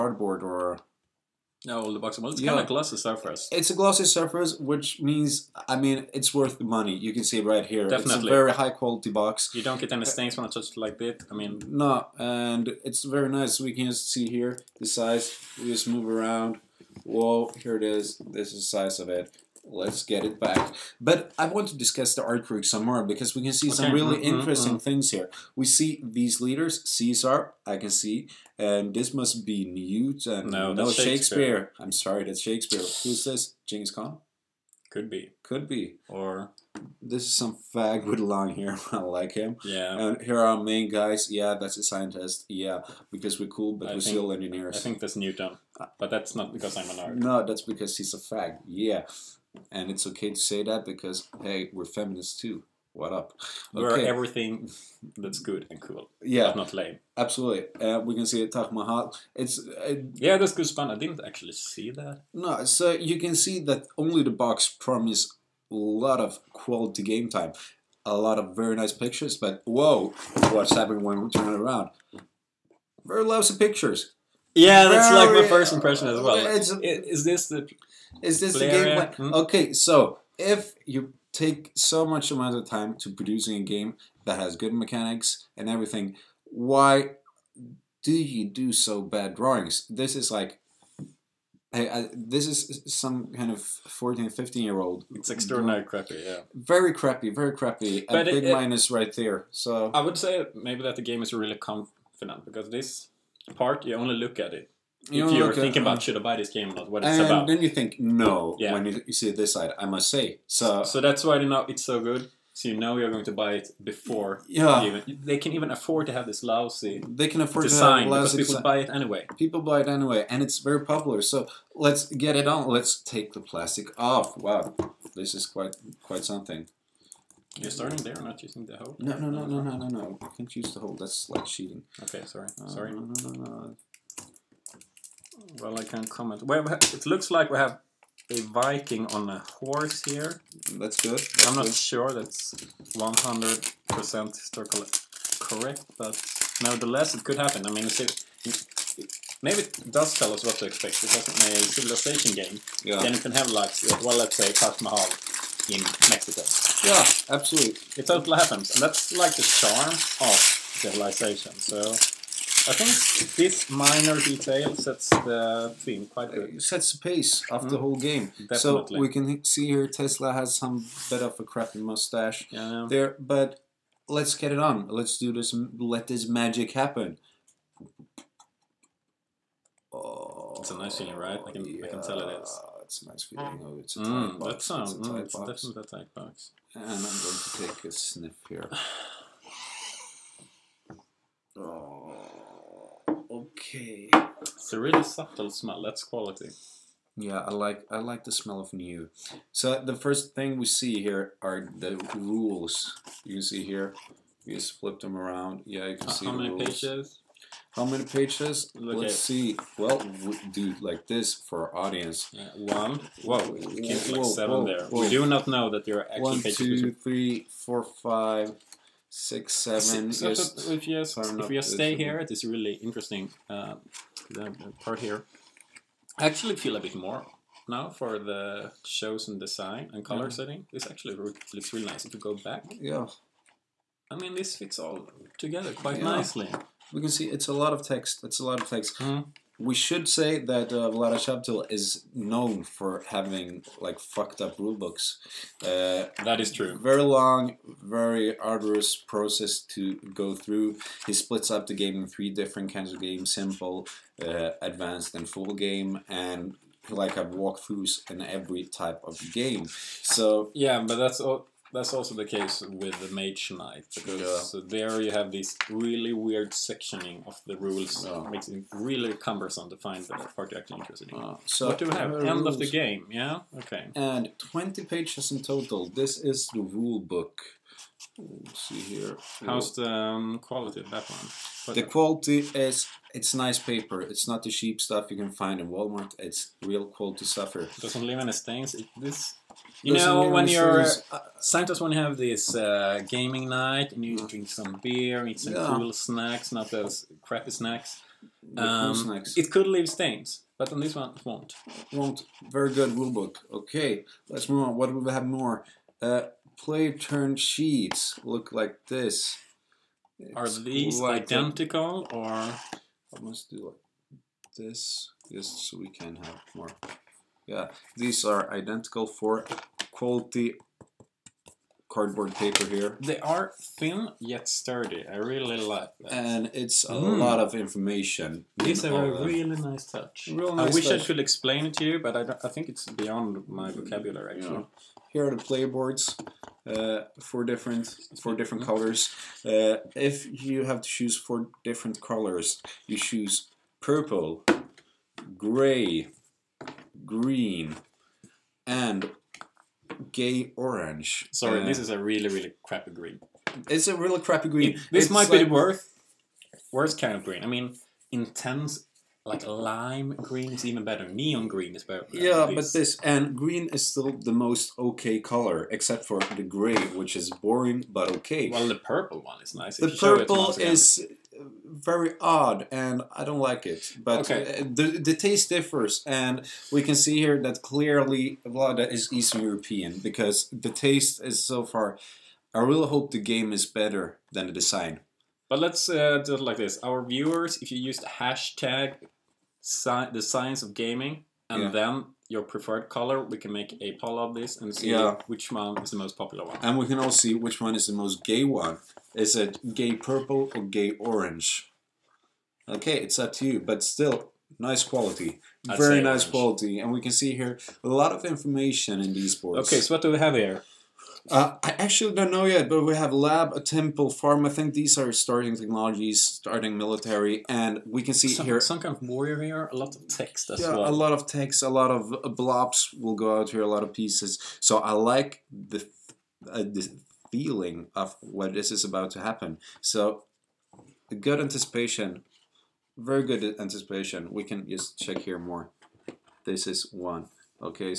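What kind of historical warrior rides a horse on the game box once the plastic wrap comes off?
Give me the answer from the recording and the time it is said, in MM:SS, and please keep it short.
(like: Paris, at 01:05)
A Viking, at 02:18.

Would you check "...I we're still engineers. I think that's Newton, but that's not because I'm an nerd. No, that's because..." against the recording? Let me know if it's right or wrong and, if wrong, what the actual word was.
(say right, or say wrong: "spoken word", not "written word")
right.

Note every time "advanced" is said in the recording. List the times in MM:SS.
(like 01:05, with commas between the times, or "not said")
04:14.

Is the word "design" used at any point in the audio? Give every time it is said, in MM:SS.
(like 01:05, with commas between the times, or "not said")
01:57, 03:49, 06:24.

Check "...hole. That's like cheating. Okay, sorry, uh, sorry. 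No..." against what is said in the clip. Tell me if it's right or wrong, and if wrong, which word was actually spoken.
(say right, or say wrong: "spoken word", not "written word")
right.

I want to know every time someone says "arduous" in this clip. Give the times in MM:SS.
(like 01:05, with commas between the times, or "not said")
04:08.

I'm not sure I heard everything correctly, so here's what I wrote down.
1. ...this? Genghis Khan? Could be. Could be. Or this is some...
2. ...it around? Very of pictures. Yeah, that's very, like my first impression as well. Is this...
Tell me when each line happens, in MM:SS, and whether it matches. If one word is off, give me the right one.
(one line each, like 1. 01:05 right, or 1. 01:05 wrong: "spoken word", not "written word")
1. 00:33 right
2. 01:11 right.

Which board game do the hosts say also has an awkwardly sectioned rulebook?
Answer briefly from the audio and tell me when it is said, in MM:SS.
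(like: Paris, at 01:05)
Mage Knight, at 04:23.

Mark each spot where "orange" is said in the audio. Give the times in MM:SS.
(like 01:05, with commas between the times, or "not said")
05:50, 06:40, 06:46.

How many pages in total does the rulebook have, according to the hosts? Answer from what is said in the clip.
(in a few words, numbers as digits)
20.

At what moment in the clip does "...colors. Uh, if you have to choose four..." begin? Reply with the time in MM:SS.
05:38.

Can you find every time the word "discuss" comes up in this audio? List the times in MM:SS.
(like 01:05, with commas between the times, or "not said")
00:21.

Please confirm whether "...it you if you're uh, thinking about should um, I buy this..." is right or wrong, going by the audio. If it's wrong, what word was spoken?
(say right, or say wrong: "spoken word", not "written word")
right.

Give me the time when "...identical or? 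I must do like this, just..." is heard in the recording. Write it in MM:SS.
05:11.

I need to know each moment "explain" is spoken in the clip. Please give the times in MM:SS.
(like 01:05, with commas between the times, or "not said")
05:31.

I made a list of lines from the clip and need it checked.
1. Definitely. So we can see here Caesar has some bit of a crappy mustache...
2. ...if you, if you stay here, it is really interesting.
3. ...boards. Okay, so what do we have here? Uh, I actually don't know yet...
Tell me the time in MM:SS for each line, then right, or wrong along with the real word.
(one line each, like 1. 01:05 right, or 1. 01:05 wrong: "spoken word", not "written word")
1. 02:48 wrong: "Tesla", not "Caesar"
2. 03:40 right
3. 06:49 right.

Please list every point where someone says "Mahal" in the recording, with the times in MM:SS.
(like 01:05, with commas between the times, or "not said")
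00:58, 02:34.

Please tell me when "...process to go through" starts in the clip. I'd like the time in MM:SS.
04:08.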